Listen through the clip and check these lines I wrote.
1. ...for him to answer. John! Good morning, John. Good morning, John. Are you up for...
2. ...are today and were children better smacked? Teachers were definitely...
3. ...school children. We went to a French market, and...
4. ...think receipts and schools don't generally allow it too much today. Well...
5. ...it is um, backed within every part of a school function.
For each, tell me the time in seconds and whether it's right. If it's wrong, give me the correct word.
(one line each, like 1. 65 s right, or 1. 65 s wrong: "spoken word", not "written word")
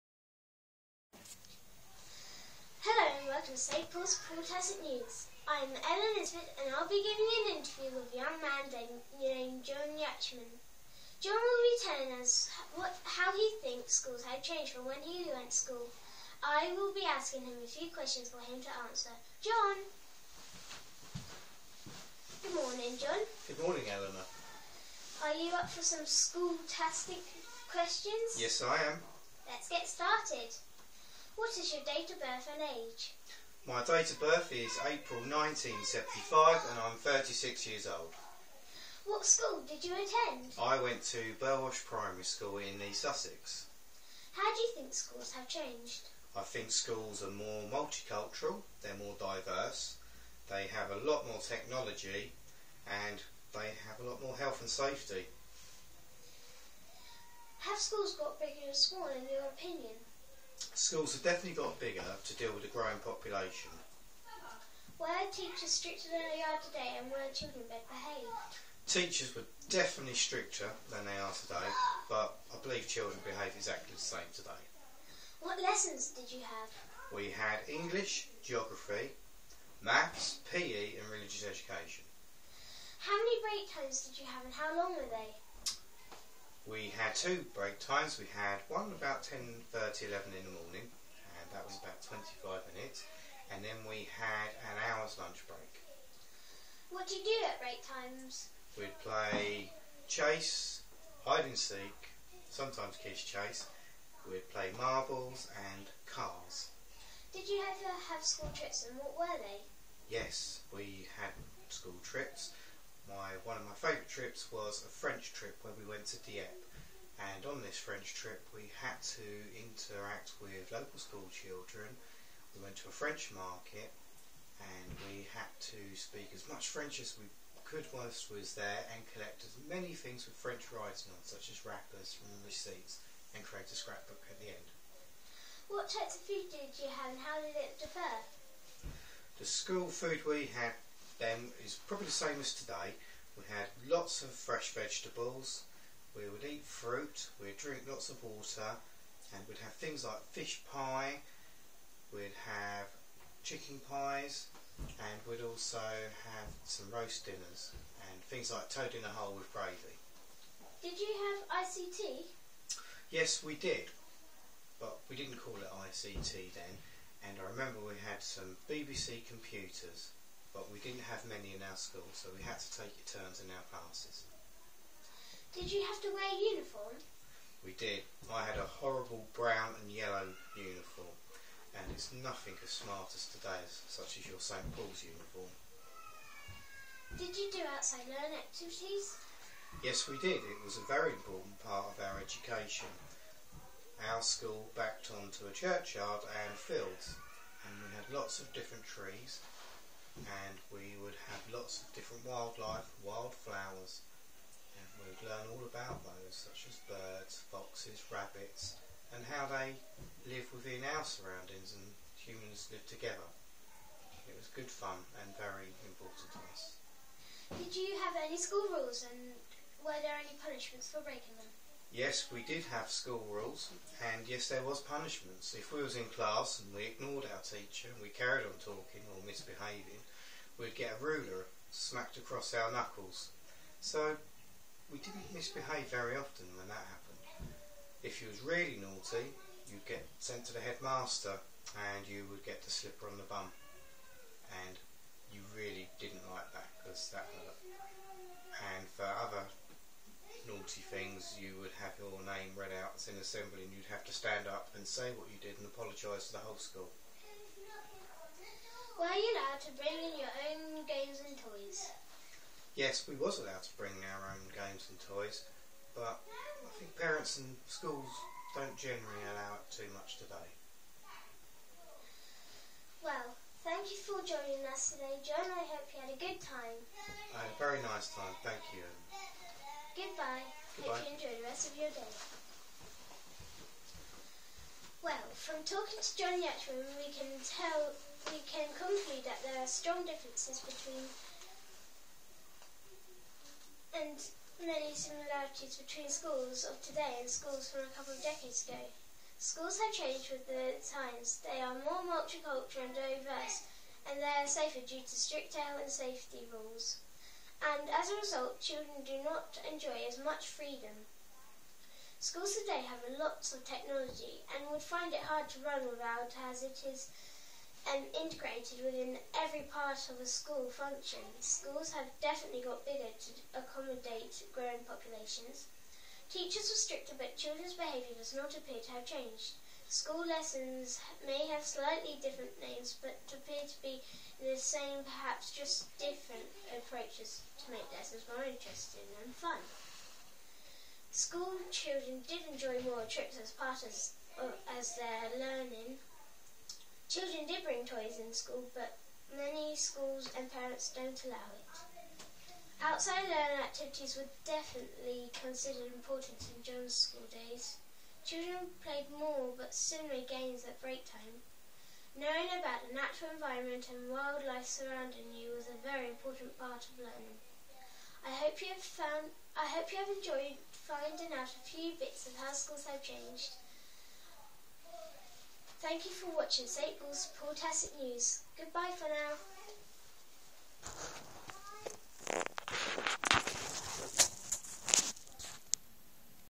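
1. 18 s wrong: "Eleanor", not "John"
2. 66 s wrong: "behaved", not "smacked"
3. 120 s right
4. 266 s wrong: "parents", not "receipts"
5. 316 s wrong: "integrated", not "backed".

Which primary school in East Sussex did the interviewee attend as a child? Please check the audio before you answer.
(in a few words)
Burwash Primary School.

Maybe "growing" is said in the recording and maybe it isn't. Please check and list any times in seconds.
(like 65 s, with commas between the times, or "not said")
62 s, 324 s.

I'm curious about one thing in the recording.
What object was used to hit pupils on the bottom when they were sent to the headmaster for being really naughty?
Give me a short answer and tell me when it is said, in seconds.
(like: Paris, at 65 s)
the slipper, at 242 s.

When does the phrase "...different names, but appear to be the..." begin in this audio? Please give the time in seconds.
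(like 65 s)
332 s.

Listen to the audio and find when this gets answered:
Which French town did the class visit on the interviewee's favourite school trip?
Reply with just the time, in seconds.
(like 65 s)
116 s.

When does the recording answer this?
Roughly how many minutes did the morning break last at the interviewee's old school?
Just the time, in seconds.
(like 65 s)
92 s.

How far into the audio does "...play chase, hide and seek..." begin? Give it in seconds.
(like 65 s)
99 s.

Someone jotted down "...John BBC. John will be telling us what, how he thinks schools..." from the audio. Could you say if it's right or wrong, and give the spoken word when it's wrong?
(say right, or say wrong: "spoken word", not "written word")
wrong: "Yachman", not "BBC".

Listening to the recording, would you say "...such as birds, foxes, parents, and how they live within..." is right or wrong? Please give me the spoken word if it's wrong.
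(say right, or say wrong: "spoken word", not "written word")
wrong: "rabbits", not "parents".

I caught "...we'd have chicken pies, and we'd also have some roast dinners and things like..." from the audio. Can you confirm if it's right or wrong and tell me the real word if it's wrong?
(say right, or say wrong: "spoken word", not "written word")
right.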